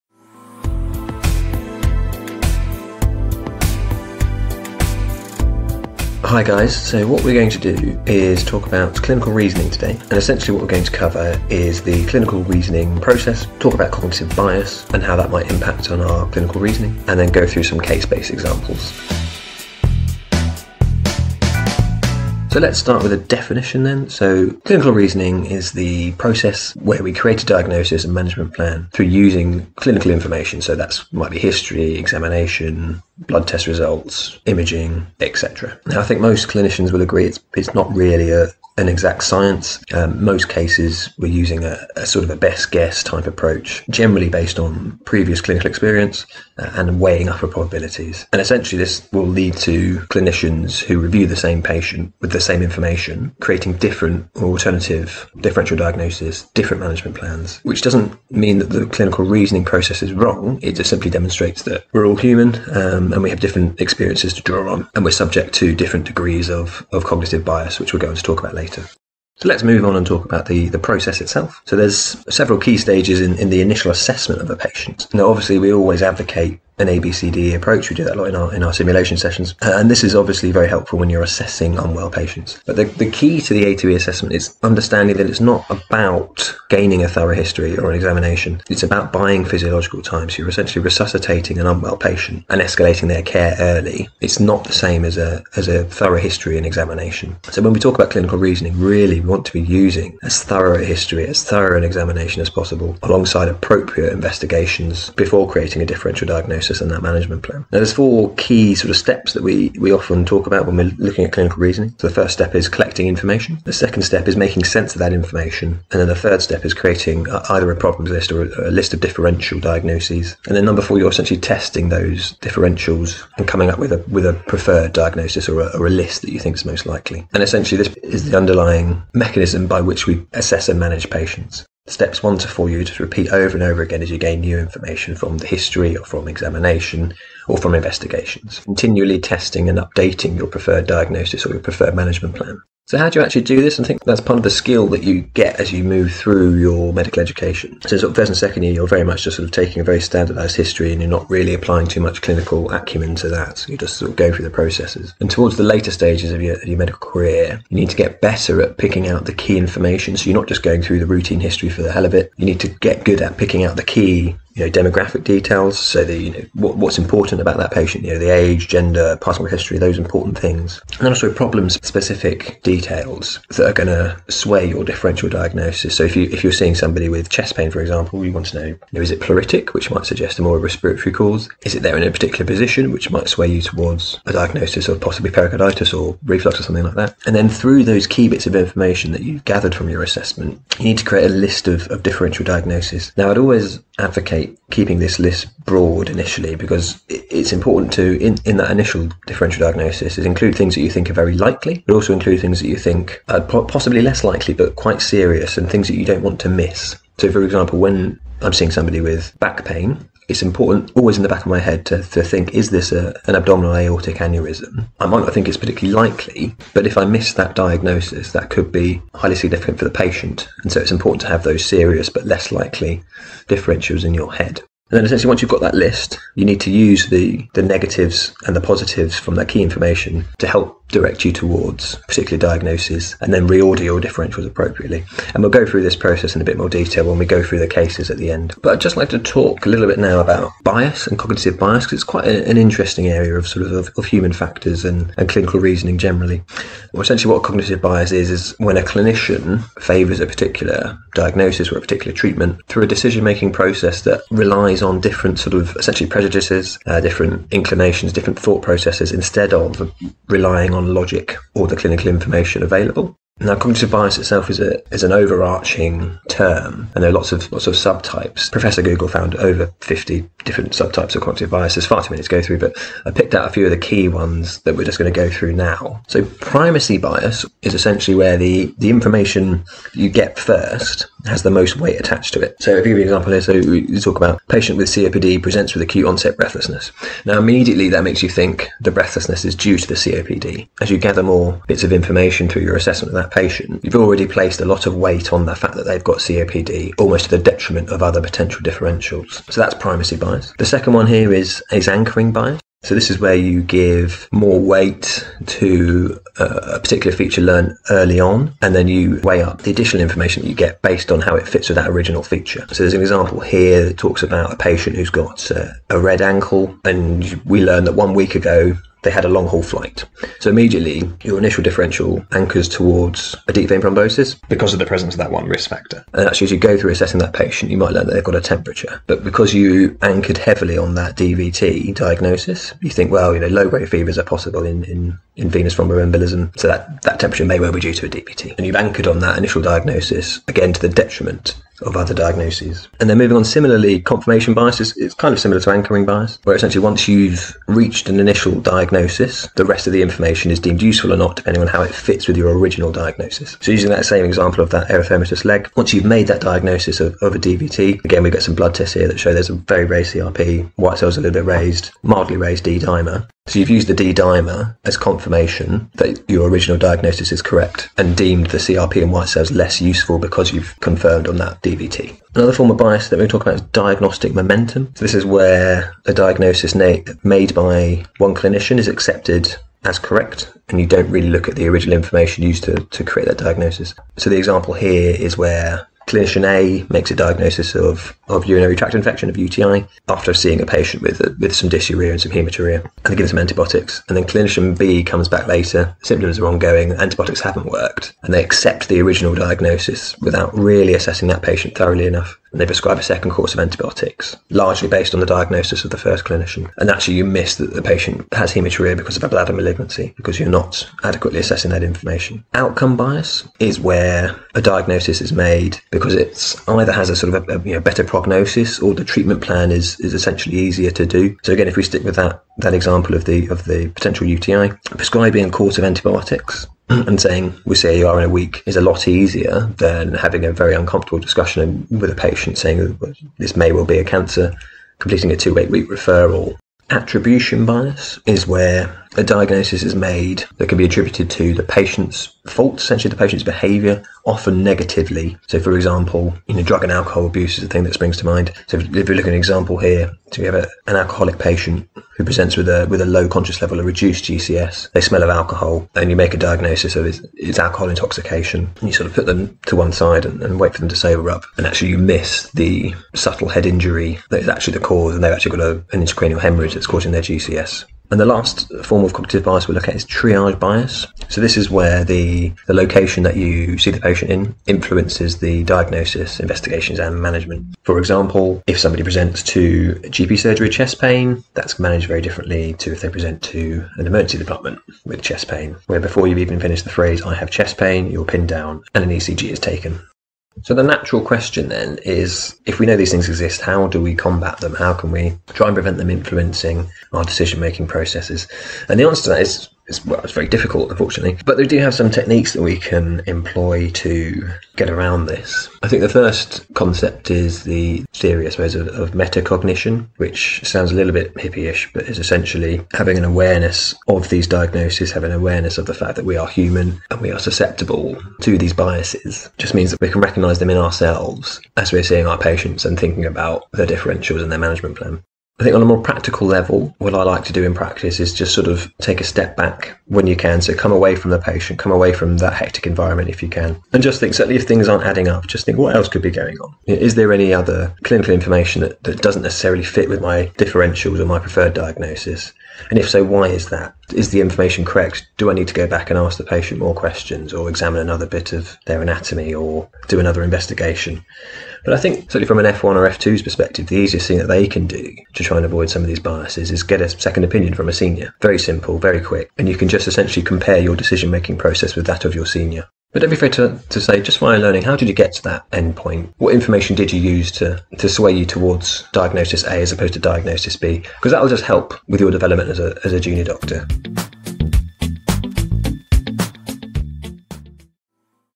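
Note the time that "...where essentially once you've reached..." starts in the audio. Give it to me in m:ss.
5:46.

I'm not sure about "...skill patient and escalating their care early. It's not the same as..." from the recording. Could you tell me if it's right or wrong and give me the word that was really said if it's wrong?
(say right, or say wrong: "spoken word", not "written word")
wrong: "unwell", not "skill".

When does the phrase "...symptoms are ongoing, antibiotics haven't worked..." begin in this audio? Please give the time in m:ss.
6:36.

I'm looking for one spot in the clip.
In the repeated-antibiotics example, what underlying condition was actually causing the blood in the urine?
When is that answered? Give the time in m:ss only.
6:49.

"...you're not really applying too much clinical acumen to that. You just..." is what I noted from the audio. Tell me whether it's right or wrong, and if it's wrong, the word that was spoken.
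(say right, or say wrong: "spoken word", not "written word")
right.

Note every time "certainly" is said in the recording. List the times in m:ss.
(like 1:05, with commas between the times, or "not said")
8:54, 9:12.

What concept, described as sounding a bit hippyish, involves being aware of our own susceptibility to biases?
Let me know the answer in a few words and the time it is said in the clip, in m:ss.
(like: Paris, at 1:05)
metacognition, at 8:29.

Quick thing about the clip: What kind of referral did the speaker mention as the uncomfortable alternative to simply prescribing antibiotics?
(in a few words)
two-week referral.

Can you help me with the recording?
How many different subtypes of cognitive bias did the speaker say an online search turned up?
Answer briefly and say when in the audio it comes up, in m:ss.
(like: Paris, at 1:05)
over 50, at 4:29.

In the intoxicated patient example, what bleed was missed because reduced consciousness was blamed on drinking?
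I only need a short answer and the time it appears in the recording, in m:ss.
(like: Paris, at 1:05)
intracranial hemorrhage, at 7:46.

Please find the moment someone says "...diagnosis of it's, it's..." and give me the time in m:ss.
7:36.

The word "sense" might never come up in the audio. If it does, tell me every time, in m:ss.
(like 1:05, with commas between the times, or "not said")
1:54.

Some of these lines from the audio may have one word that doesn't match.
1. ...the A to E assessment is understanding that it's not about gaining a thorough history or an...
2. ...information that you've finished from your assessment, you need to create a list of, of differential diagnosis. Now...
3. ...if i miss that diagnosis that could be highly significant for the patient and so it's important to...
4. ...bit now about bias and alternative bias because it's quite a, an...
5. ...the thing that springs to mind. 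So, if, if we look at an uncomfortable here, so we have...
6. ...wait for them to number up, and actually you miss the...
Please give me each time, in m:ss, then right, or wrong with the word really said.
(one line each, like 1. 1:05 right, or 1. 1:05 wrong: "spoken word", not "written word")
1. 1:23 right
2. 3:08 wrong: "gathered", not "finished"
3. 3:36 right
4. 3:59 wrong: "cognitive", not "alternative"
5. 7:27 wrong: "example", not "uncomfortable"
6. 7:40 wrong: "sober", not "number".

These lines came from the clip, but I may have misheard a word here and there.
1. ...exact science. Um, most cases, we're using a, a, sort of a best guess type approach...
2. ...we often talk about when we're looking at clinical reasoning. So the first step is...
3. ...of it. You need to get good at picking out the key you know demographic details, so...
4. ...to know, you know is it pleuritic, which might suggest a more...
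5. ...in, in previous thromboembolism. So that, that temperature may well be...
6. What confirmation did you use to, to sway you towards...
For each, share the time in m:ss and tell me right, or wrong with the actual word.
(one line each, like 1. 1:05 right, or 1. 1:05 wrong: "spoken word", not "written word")
1. 0:38 right
2. 1:49 right
3. 2:42 right
4. 2:58 right
5. 5:34 wrong: "venous", not "previous"
6. 9:26 wrong: "information", not "confirmation".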